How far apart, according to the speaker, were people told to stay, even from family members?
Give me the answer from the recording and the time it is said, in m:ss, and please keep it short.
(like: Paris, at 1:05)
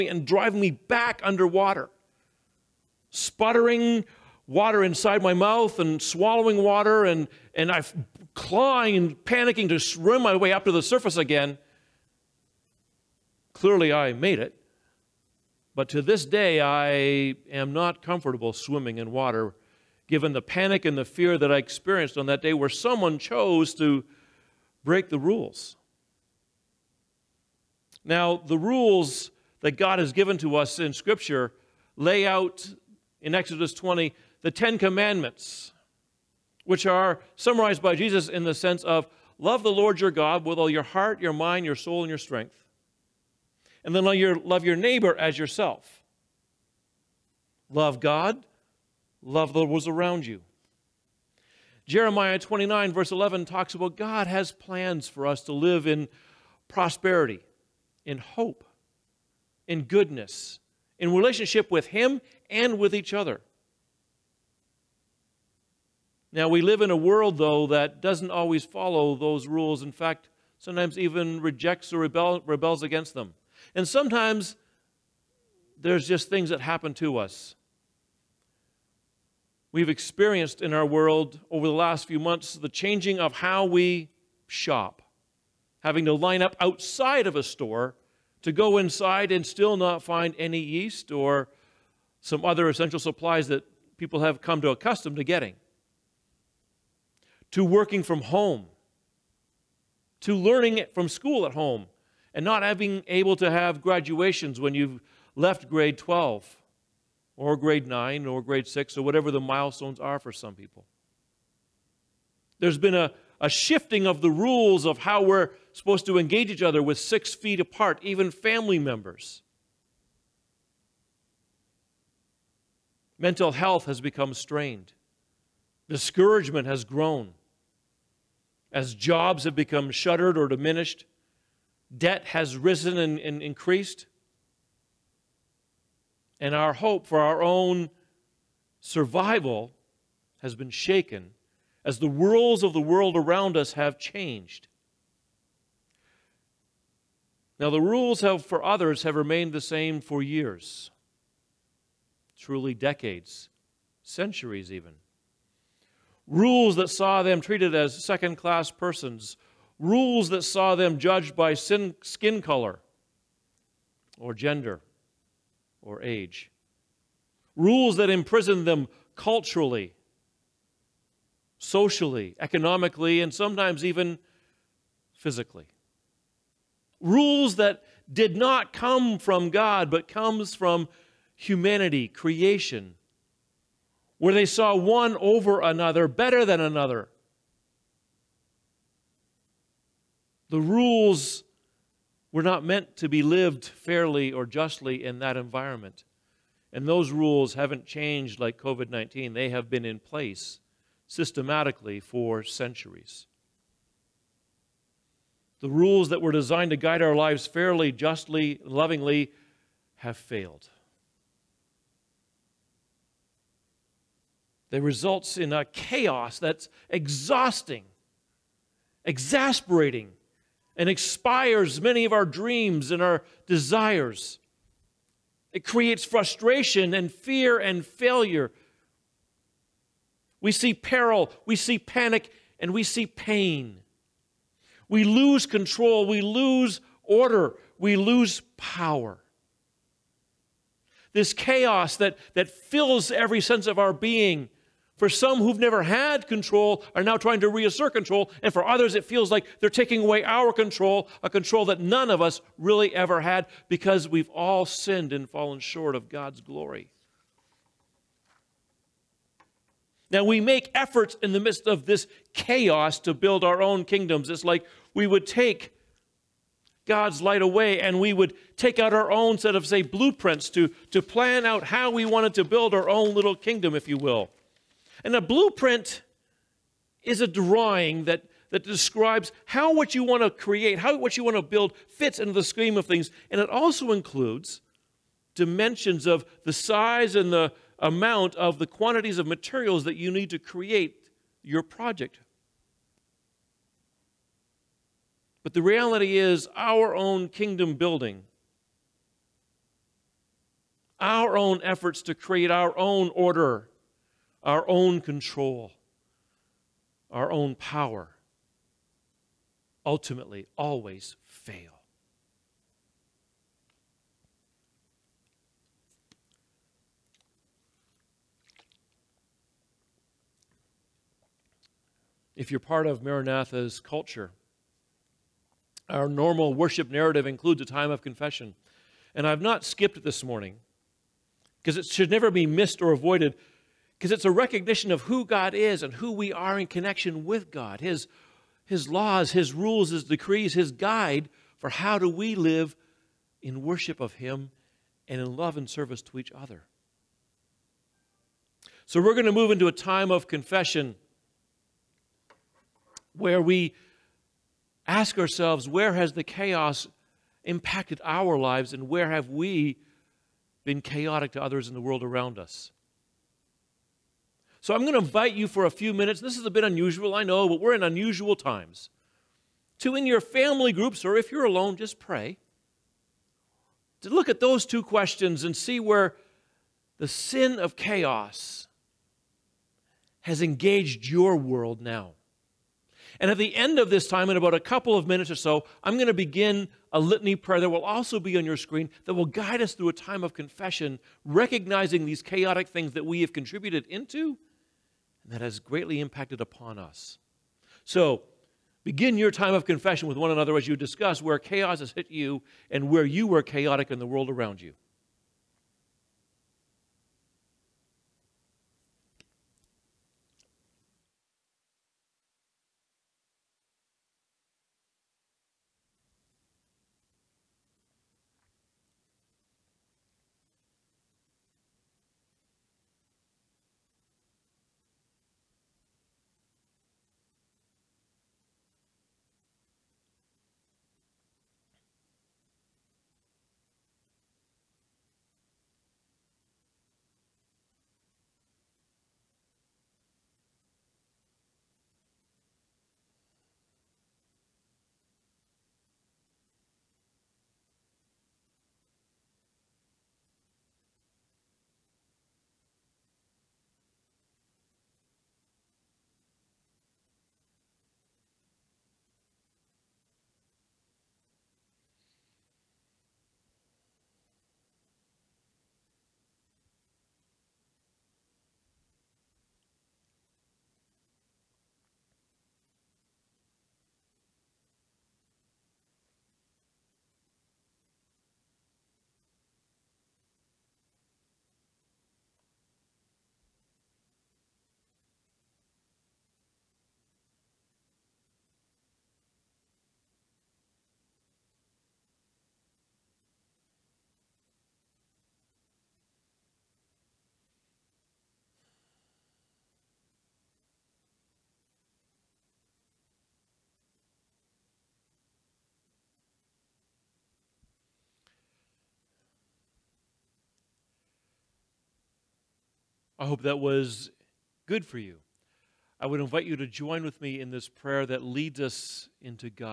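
6 feet, at 1:56.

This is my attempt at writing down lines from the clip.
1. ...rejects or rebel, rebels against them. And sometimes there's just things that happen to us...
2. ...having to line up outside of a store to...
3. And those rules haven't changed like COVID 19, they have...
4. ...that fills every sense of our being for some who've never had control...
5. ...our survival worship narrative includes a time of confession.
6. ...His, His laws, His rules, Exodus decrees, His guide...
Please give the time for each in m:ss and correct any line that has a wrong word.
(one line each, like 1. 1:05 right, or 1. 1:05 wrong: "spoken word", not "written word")
1. 1:11 right
2. 1:25 right
3. 3:16 right
4. 4:02 right
5. 5:25 wrong: "normal", not "survival"
6. 5:37 wrong: "His", not "Exodus".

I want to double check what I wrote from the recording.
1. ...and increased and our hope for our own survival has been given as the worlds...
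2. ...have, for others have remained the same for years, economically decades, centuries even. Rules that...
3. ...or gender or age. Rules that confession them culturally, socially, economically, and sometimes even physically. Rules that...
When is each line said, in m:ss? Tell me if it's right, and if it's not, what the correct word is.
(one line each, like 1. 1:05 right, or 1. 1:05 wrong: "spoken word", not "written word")
1. 2:13 wrong: "shaken", not "given"
2. 2:28 wrong: "truly", not "economically"
3. 2:44 wrong: "imprison", not "confession".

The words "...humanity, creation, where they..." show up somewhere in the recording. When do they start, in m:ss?
3:01.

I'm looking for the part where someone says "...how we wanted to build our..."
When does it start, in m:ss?
4:31.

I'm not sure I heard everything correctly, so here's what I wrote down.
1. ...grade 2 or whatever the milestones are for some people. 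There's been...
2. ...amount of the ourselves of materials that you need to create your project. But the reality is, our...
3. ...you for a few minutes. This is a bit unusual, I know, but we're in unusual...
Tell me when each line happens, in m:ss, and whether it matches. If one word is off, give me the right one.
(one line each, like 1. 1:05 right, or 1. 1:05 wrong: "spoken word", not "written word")
1. 1:48 wrong: "6", not "2"
2. 4:47 wrong: "quantities", not "ourselves"
3. 6:05 right.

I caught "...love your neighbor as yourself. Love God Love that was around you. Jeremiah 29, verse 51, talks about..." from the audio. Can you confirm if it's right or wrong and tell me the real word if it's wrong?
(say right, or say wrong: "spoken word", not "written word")
wrong: "11", not "51".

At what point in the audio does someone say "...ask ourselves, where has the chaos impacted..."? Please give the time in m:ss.
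5:54.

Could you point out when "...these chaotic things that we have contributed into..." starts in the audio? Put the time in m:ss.
6:32.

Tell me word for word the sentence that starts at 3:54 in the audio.
We lose control, we lose order, we lose power.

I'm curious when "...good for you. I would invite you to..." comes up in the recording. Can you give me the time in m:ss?
8:34.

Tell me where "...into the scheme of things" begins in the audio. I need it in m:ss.
4:42.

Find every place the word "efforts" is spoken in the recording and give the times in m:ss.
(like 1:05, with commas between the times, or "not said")
4:20, 5:01.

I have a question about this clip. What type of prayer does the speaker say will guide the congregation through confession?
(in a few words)
litany prayer.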